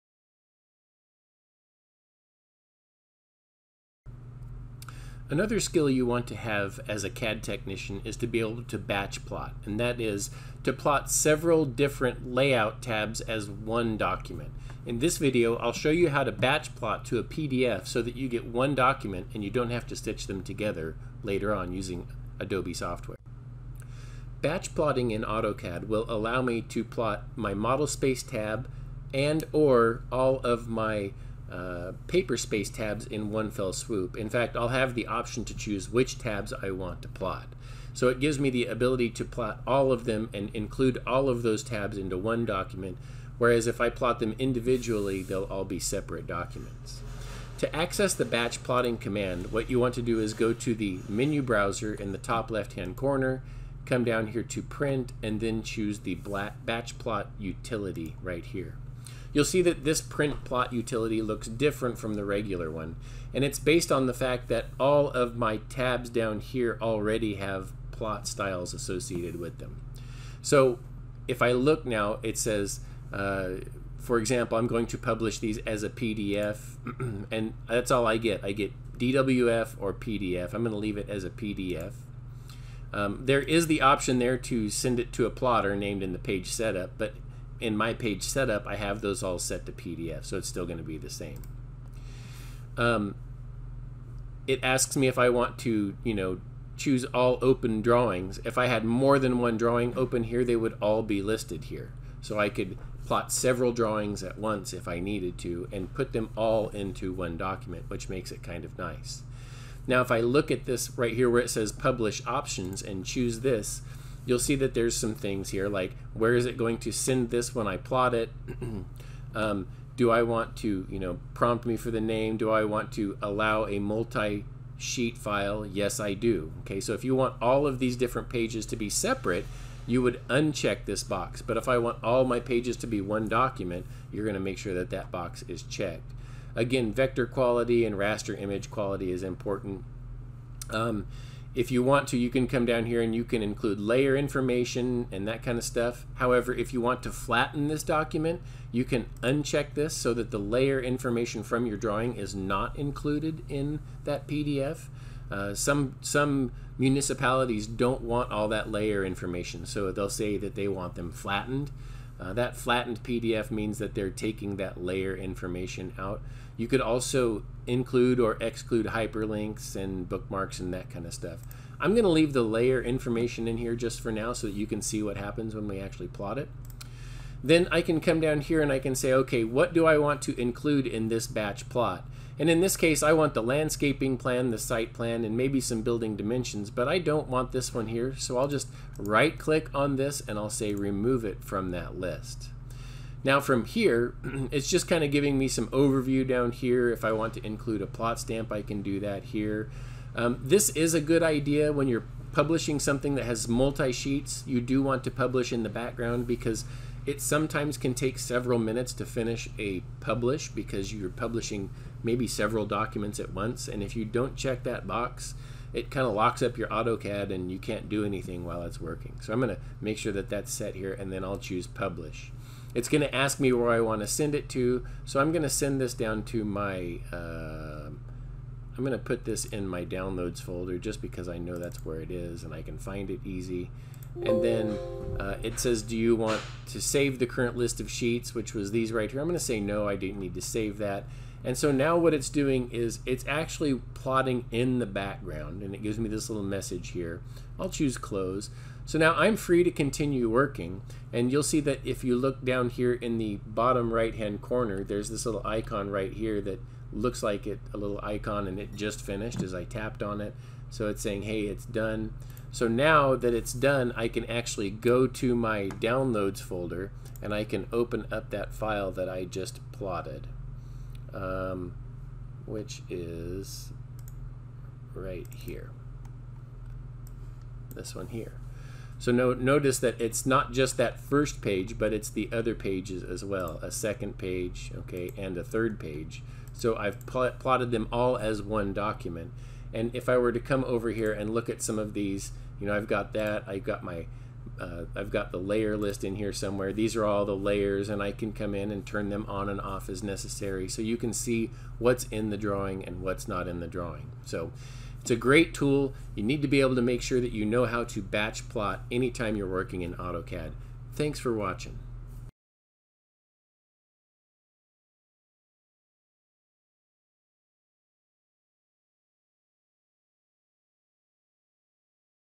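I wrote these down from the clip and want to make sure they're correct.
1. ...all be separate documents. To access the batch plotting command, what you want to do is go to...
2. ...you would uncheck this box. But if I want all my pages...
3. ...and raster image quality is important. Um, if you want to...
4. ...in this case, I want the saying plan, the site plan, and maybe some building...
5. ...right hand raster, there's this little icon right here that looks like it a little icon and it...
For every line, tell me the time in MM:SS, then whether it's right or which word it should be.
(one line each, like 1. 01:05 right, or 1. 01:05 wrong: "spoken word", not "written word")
1. 00:45 right
2. 02:09 right
3. 02:17 right
4. 03:02 wrong: "landscaping", not "saying"
5. 04:13 wrong: "corner", not "raster".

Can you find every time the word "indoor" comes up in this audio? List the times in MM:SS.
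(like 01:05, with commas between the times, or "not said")
not said.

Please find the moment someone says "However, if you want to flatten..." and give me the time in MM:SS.
02:26.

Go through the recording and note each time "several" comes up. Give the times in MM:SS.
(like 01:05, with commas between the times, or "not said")
00:11, 01:43, 03:28, 03:32.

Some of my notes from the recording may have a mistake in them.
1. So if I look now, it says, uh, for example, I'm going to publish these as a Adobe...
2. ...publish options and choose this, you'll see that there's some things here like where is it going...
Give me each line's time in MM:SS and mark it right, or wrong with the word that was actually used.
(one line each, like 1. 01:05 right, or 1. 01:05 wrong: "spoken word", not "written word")
1. 01:10 wrong: "PDF", not "Adobe"
2. 01:51 right.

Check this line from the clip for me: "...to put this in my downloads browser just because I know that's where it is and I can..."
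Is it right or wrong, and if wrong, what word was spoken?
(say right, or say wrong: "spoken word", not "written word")
wrong: "folder", not "browser".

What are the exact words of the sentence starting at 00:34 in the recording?
In fact, I'll have the option to choose which tabs I want to plot.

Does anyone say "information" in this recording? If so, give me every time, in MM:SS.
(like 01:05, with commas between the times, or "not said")
02:24, 02:30, 02:39, 02:45, 02:52.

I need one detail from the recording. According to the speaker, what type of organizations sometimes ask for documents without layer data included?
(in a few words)
municipalities.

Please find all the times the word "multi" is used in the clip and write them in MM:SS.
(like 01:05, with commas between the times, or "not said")
02:03, 03:23.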